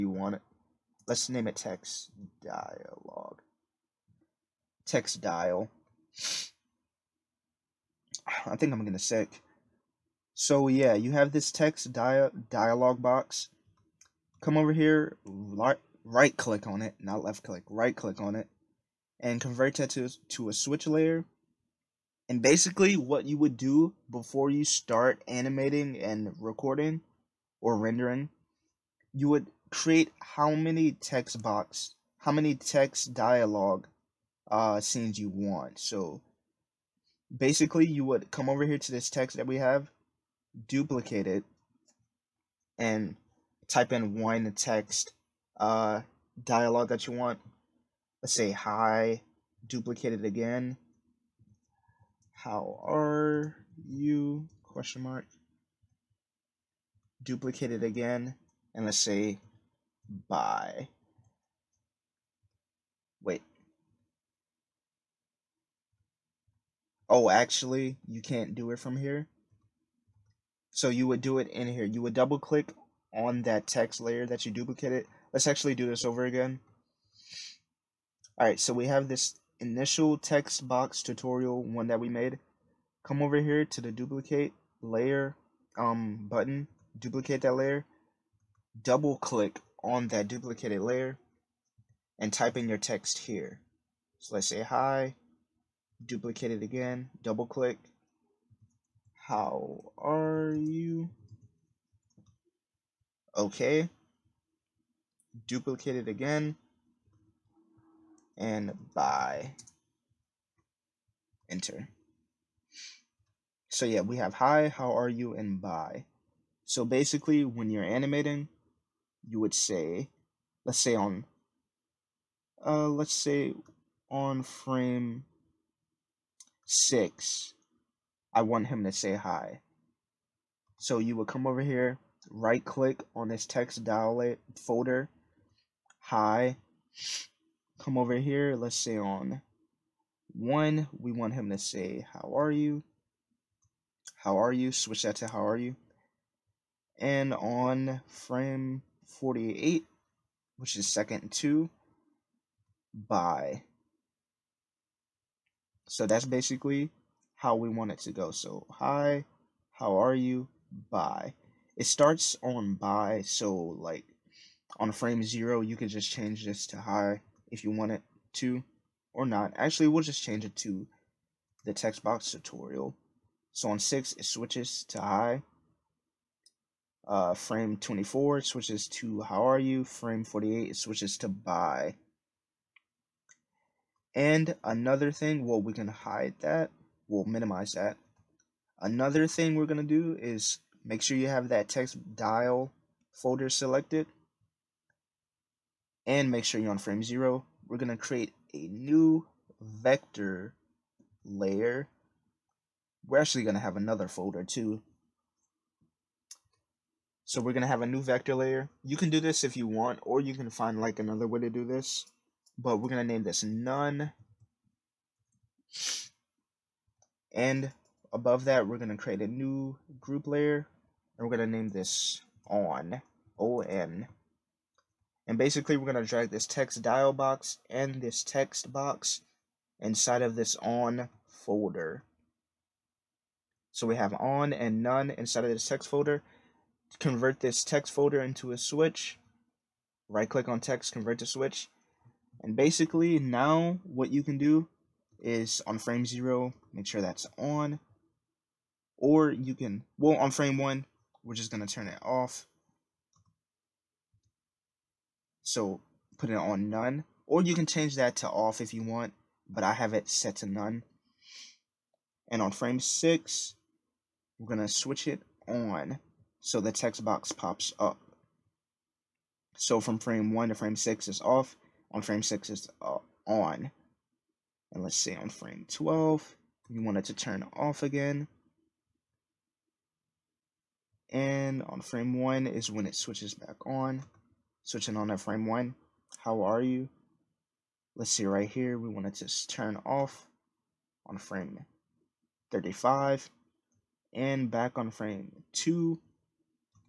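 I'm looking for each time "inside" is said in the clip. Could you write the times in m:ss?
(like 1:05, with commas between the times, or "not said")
3:49, 3:55.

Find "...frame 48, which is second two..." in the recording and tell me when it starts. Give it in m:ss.
2:28.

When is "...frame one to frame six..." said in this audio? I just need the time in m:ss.
4:29.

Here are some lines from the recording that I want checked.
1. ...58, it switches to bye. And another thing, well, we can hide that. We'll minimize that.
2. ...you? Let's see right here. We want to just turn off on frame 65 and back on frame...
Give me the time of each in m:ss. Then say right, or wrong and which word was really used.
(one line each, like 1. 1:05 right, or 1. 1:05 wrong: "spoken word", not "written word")
1. 3:00 wrong: "48", not "58"
2. 4:46 wrong: "35", not "65".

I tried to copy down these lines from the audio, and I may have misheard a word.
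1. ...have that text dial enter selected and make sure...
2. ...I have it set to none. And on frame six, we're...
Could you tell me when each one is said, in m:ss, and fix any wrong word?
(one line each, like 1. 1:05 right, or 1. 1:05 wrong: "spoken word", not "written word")
1. 3:11 wrong: "folder", not "enter"
2. 4:19 right.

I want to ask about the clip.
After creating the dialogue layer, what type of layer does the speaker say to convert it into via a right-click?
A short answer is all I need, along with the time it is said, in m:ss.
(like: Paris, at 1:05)
switch layer, at 0:20.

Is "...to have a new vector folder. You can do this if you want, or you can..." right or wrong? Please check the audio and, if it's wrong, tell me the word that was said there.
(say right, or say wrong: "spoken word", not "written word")
wrong: "layer", not "folder".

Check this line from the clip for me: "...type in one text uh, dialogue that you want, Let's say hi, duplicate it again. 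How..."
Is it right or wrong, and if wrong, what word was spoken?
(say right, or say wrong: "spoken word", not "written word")
right.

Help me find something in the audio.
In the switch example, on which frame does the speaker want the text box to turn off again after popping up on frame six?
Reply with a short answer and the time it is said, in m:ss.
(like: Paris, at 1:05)
12, at 4:35.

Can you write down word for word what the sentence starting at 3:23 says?
We're actually going to have another folder too.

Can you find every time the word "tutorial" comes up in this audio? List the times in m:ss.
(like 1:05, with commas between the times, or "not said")
1:21, 2:52.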